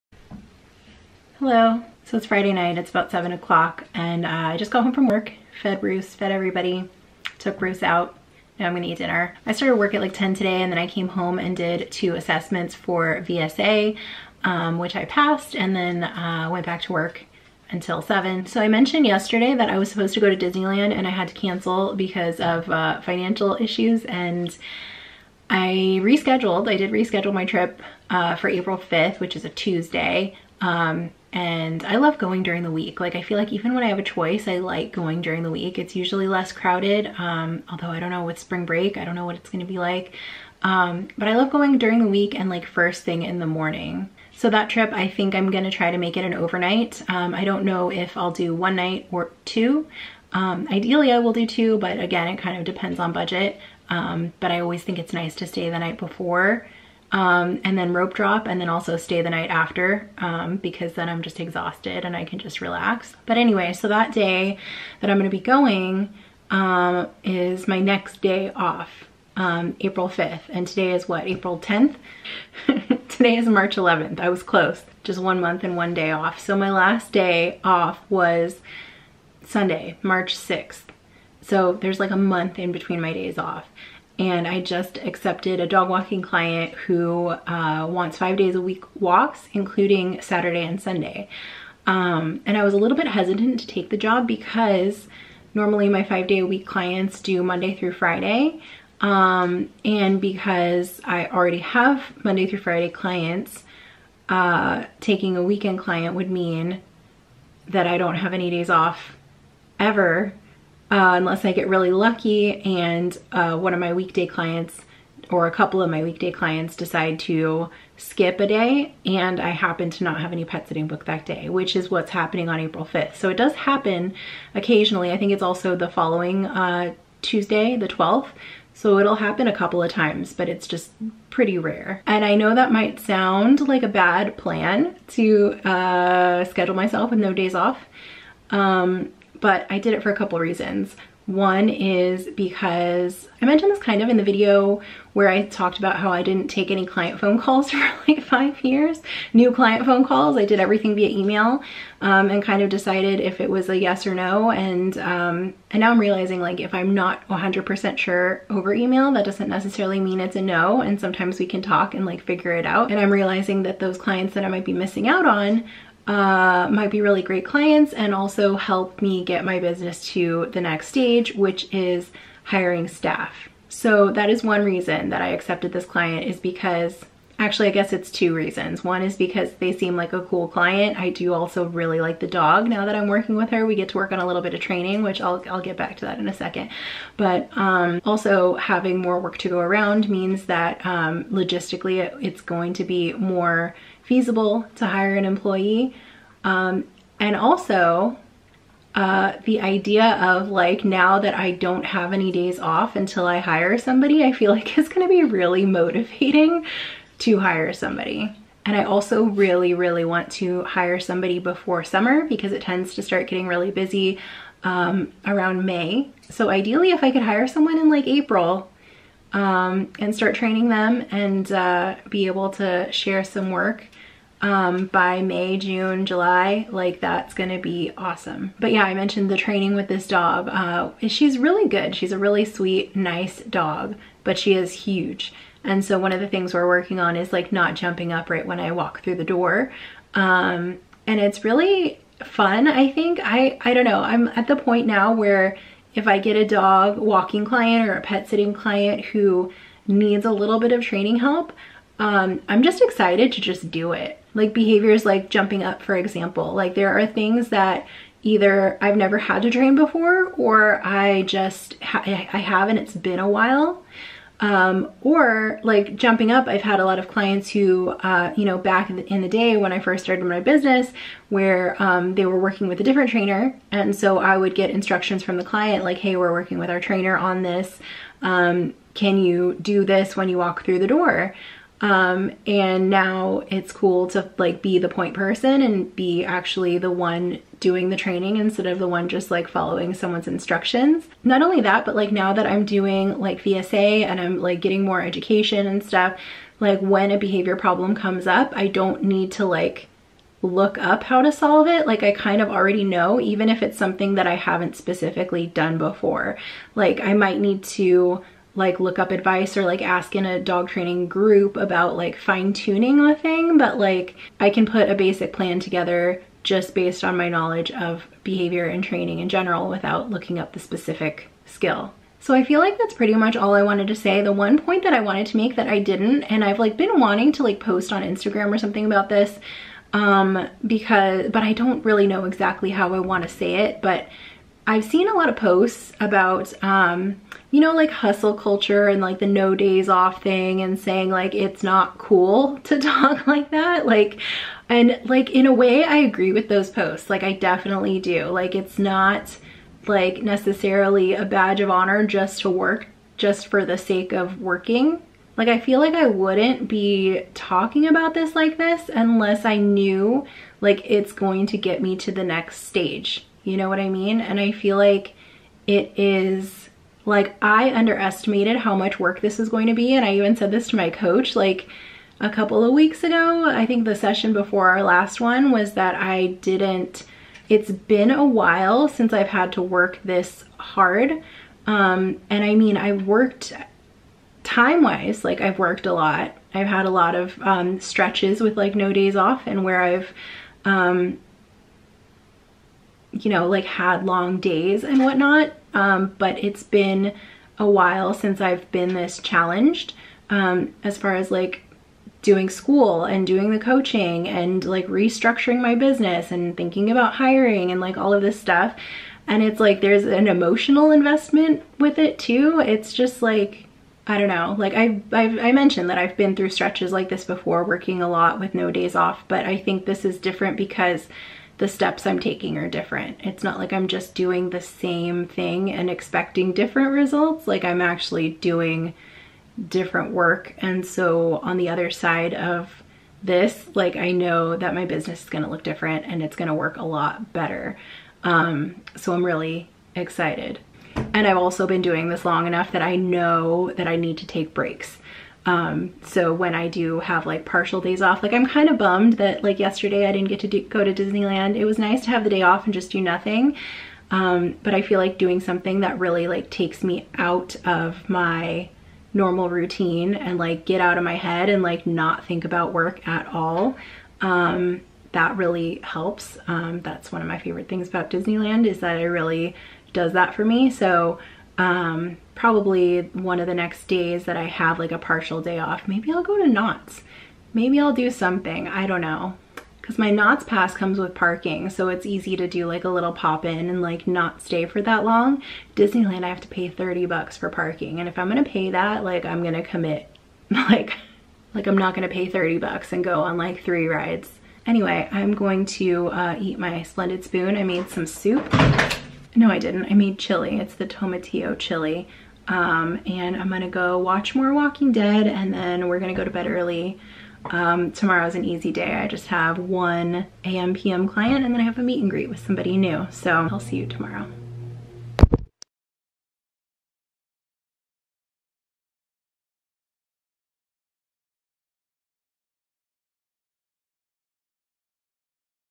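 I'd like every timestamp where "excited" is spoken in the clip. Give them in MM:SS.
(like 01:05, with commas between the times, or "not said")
04:12, 07:19.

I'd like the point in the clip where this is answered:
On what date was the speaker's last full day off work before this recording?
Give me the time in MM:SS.
01:19.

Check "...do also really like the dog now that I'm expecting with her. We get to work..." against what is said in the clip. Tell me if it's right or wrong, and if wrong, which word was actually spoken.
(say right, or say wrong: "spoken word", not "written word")
wrong: "working", not "expecting".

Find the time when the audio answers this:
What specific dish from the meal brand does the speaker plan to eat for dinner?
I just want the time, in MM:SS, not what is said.
08:20.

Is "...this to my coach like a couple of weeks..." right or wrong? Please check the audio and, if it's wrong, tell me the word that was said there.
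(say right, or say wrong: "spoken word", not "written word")
right.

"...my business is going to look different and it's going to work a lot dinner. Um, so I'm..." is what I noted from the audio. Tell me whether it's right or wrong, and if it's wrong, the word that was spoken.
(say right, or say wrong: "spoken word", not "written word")
wrong: "better", not "dinner".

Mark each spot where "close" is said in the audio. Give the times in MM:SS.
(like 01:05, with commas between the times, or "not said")
01:14.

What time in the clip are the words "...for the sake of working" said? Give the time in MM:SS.
05:53.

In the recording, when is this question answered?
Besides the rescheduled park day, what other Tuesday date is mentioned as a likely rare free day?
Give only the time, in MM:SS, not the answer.
02:07.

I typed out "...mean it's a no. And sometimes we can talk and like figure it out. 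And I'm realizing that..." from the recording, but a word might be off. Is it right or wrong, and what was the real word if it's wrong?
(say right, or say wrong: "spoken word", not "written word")
right.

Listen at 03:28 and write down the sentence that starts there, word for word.
And I also really, really want to hire somebody before summer because it tends to start getting really busy um, around May.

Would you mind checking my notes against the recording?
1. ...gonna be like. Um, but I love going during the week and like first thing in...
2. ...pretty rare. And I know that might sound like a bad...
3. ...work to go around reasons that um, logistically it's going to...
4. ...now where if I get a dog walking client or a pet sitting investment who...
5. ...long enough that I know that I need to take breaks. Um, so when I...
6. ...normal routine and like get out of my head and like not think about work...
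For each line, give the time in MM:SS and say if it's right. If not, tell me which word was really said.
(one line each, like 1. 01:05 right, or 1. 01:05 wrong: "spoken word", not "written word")
1. 00:39 right
2. 02:11 right
3. 03:09 wrong: "means", not "reasons"
4. 04:04 wrong: "client", not "investment"
5. 07:22 right
6. 07:39 right.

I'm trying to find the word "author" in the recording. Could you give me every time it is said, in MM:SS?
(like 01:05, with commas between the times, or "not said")
not said.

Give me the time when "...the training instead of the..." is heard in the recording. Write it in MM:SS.
04:47.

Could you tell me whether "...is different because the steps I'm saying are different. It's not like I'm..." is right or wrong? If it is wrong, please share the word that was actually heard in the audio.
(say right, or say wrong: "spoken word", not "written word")
wrong: "taking", not "saying".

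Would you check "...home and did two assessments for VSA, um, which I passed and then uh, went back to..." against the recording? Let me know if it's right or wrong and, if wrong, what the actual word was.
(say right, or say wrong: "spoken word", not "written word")
right.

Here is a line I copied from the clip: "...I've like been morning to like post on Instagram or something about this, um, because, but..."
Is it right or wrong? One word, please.
wrong.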